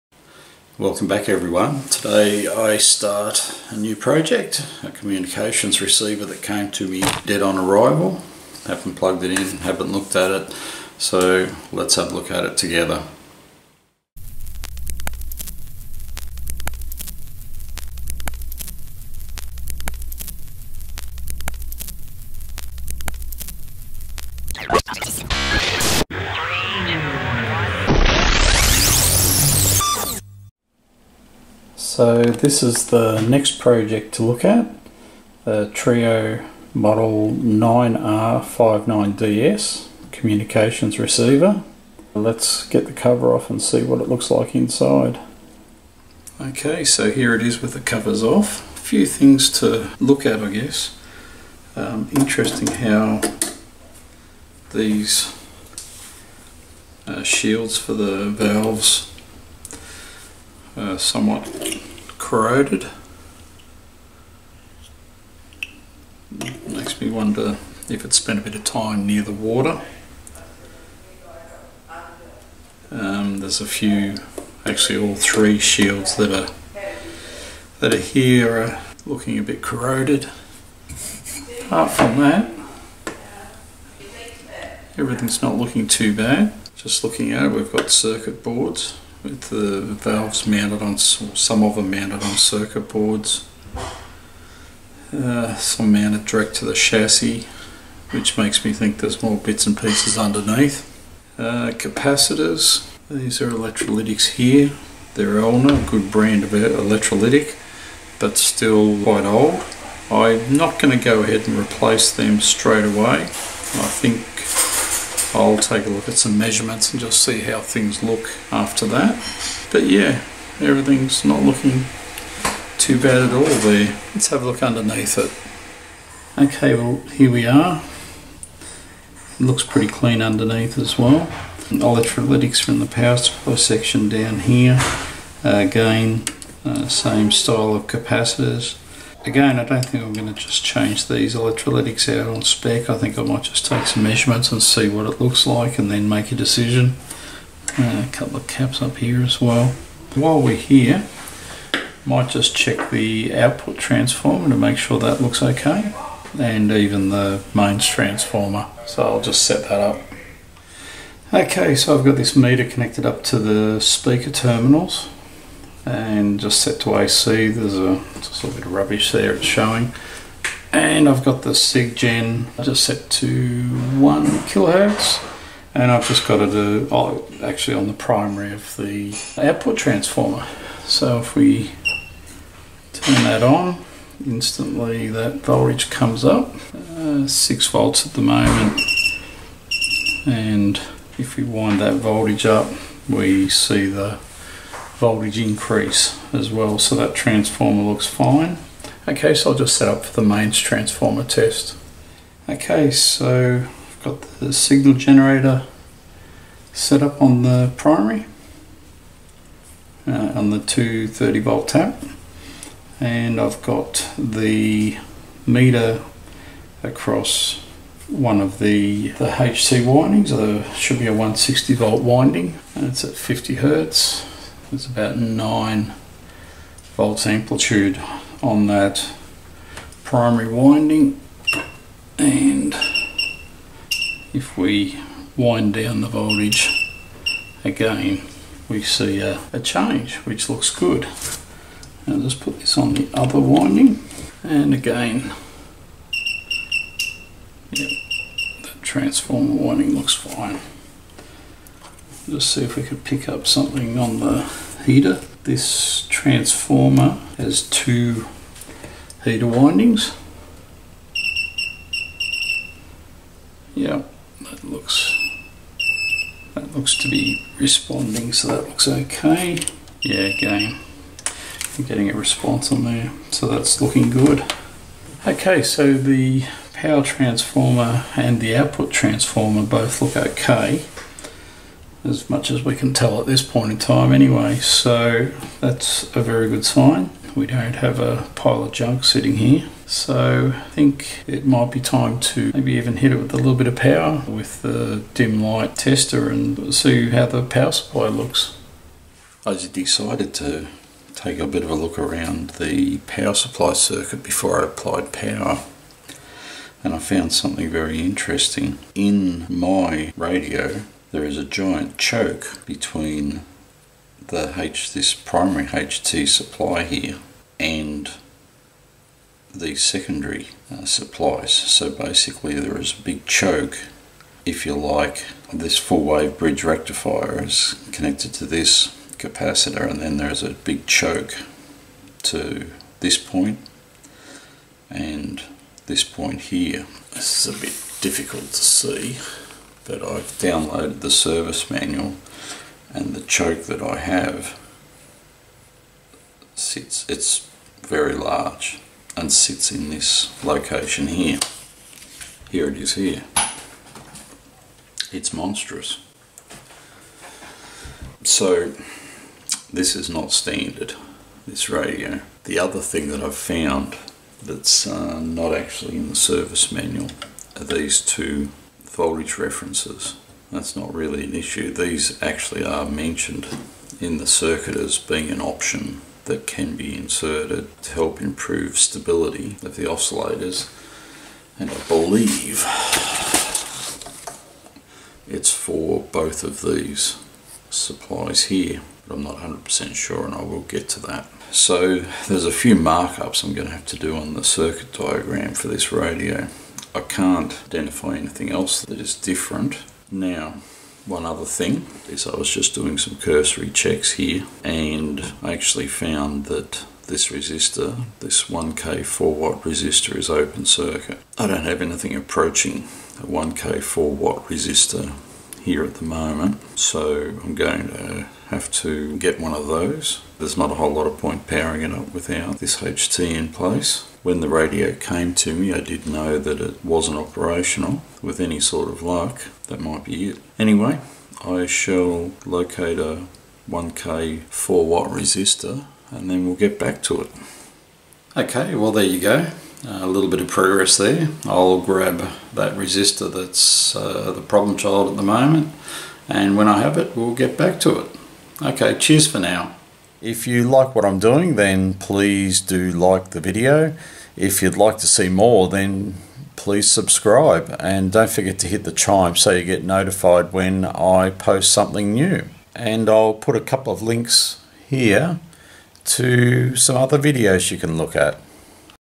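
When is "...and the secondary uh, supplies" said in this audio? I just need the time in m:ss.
5:17.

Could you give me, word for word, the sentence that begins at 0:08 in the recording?
Haven't plugged it in, haven't looked at it, so let's have a look at it together.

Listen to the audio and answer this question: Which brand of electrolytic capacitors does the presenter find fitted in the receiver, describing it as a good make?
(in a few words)
Elna.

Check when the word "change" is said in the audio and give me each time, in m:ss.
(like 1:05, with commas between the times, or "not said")
2:20, 3:59.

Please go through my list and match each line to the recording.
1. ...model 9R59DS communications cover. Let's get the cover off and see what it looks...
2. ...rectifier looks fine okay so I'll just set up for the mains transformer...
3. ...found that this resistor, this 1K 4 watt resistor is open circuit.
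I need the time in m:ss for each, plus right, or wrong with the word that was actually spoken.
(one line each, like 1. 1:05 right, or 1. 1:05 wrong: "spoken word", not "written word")
1. 0:36 wrong: "receiver", not "cover"
2. 3:17 wrong: "transformer", not "rectifier"
3. 6:45 right.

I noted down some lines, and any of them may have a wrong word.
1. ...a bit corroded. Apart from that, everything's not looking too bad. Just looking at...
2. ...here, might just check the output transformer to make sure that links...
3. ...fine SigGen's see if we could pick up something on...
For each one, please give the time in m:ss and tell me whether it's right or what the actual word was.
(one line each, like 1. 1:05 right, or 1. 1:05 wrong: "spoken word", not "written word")
1. 1:19 right
2. 2:30 wrong: "looks", not "links"
3. 4:10 wrong: "Let", not "SigGen".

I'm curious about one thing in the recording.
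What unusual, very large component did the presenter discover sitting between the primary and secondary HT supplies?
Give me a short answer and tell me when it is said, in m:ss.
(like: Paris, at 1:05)
A giant choke, at 5:11.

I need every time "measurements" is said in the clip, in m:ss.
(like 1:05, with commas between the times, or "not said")
1:56, 2:24.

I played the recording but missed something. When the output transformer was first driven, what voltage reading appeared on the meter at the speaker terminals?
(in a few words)
6 volts.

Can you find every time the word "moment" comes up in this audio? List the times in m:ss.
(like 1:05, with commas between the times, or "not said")
3:08, 6:56, 7:25.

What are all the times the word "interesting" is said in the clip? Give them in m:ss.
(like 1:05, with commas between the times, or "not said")
0:52, 5:07.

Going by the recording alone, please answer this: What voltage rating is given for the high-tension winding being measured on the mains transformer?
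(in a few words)
160 volts.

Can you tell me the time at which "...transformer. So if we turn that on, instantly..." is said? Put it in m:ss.
2:59.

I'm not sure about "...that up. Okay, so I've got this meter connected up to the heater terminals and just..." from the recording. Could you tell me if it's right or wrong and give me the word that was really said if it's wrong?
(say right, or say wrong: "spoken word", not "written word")
wrong: "speaker", not "heater".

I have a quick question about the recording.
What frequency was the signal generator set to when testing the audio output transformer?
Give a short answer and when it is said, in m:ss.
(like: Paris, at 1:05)
1 kilohertz, at 2:53.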